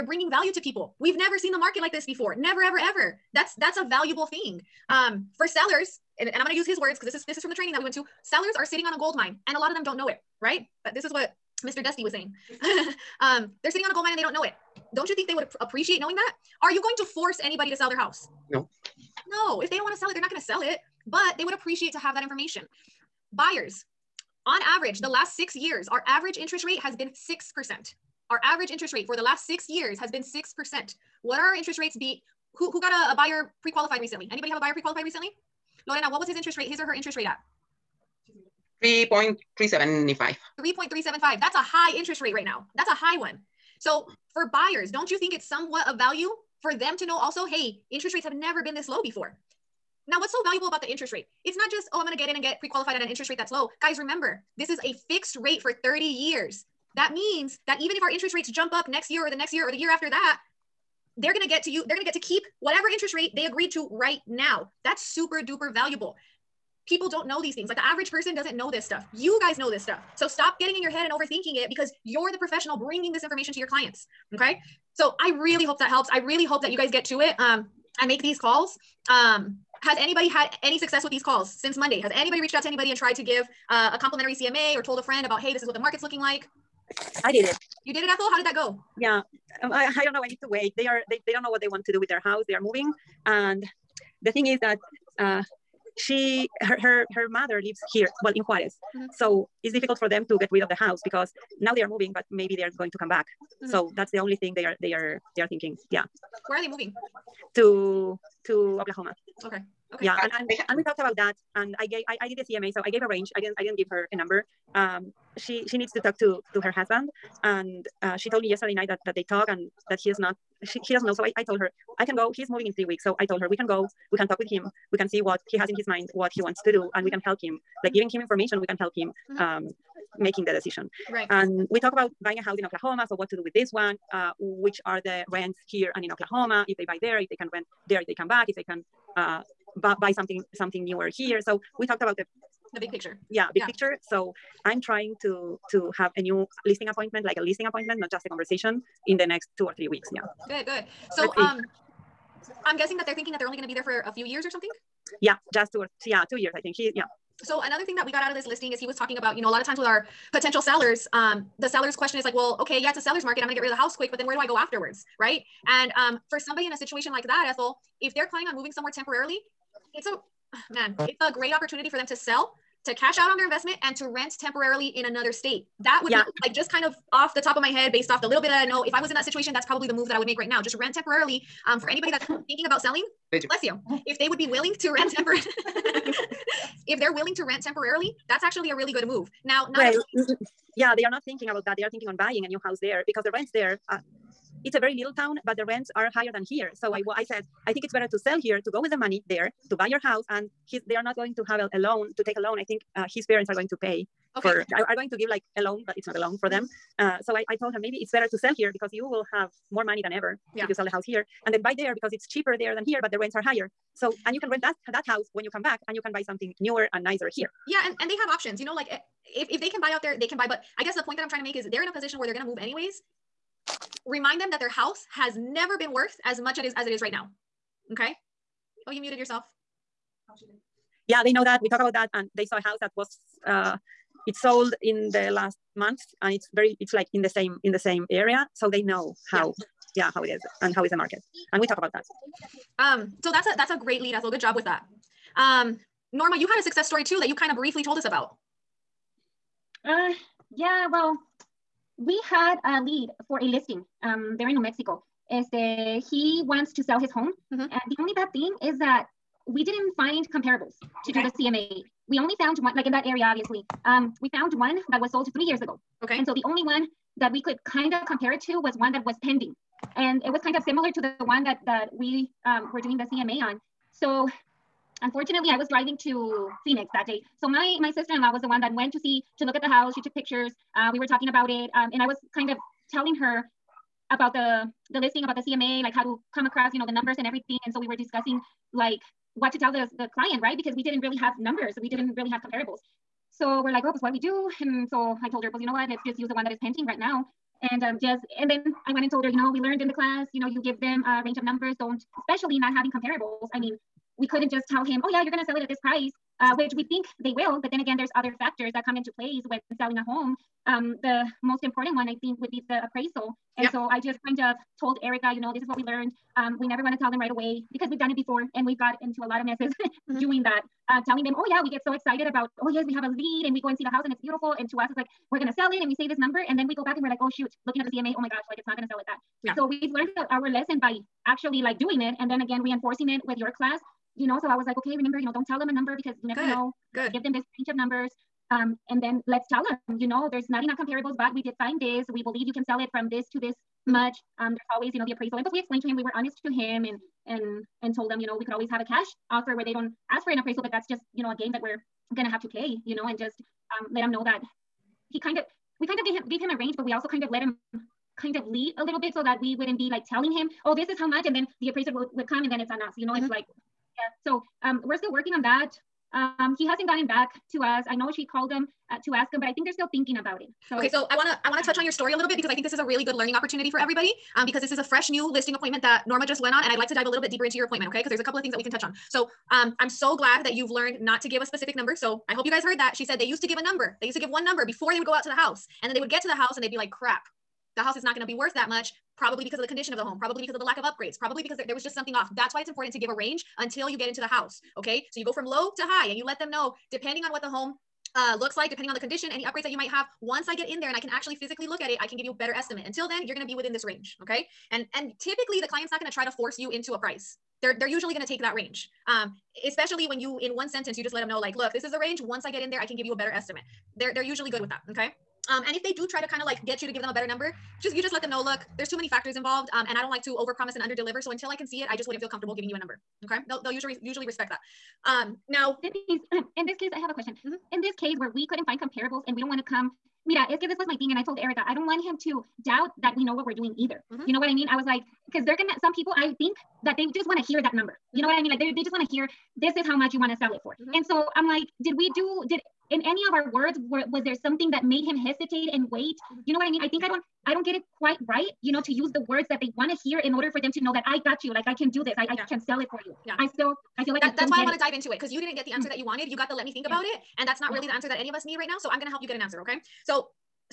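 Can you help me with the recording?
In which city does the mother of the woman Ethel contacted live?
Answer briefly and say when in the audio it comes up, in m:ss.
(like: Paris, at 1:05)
Juarez, at 1:38.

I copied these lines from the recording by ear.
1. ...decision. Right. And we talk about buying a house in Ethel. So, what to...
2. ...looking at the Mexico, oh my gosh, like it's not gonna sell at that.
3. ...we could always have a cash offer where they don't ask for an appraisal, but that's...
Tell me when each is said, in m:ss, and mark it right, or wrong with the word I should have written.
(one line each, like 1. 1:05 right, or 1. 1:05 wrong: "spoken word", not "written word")
1. 2:10 wrong: "Oklahoma", not "Ethel"
2. 5:27 wrong: "CMA", not "Mexico"
3. 5:48 right.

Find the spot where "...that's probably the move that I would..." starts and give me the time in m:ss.
2:59.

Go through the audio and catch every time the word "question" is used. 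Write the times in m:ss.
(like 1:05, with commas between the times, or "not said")
2:41, 7:07.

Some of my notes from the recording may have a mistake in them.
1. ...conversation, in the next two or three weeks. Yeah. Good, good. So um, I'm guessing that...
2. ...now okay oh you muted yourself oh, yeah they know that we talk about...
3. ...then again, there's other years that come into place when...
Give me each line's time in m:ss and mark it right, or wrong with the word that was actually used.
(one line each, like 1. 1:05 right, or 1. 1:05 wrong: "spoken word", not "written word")
1. 2:28 right
2. 3:47 right
3. 5:07 wrong: "factors", not "years".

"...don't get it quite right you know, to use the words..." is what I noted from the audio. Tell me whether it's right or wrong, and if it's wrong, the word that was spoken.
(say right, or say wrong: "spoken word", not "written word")
right.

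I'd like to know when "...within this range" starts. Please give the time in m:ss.
6:43.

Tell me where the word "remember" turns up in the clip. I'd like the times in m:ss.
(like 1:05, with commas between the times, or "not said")
0:53, 5:34.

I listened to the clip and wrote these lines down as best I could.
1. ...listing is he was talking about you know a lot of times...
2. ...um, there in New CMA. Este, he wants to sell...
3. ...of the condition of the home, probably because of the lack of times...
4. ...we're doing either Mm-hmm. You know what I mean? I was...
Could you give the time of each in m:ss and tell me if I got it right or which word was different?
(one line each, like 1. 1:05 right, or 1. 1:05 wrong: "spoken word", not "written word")
1. 2:38 right
2. 4:14 wrong: "Mexico", not "CMA"
3. 6:29 wrong: "upgrades", not "times"
4. 7:13 right.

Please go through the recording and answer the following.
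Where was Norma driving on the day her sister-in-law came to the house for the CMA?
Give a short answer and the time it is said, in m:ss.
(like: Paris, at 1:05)
Phoenix, at 4:36.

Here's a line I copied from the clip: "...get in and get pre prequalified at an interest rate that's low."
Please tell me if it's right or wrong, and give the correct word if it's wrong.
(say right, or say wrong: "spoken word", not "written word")
wrong: "qualified", not "prequalified".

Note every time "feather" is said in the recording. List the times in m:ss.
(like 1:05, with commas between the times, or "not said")
not said.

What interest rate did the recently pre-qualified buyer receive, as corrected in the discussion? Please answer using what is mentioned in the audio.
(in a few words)
3.375.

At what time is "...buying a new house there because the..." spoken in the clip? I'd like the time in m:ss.
3:12.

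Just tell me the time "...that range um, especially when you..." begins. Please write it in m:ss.
6:48.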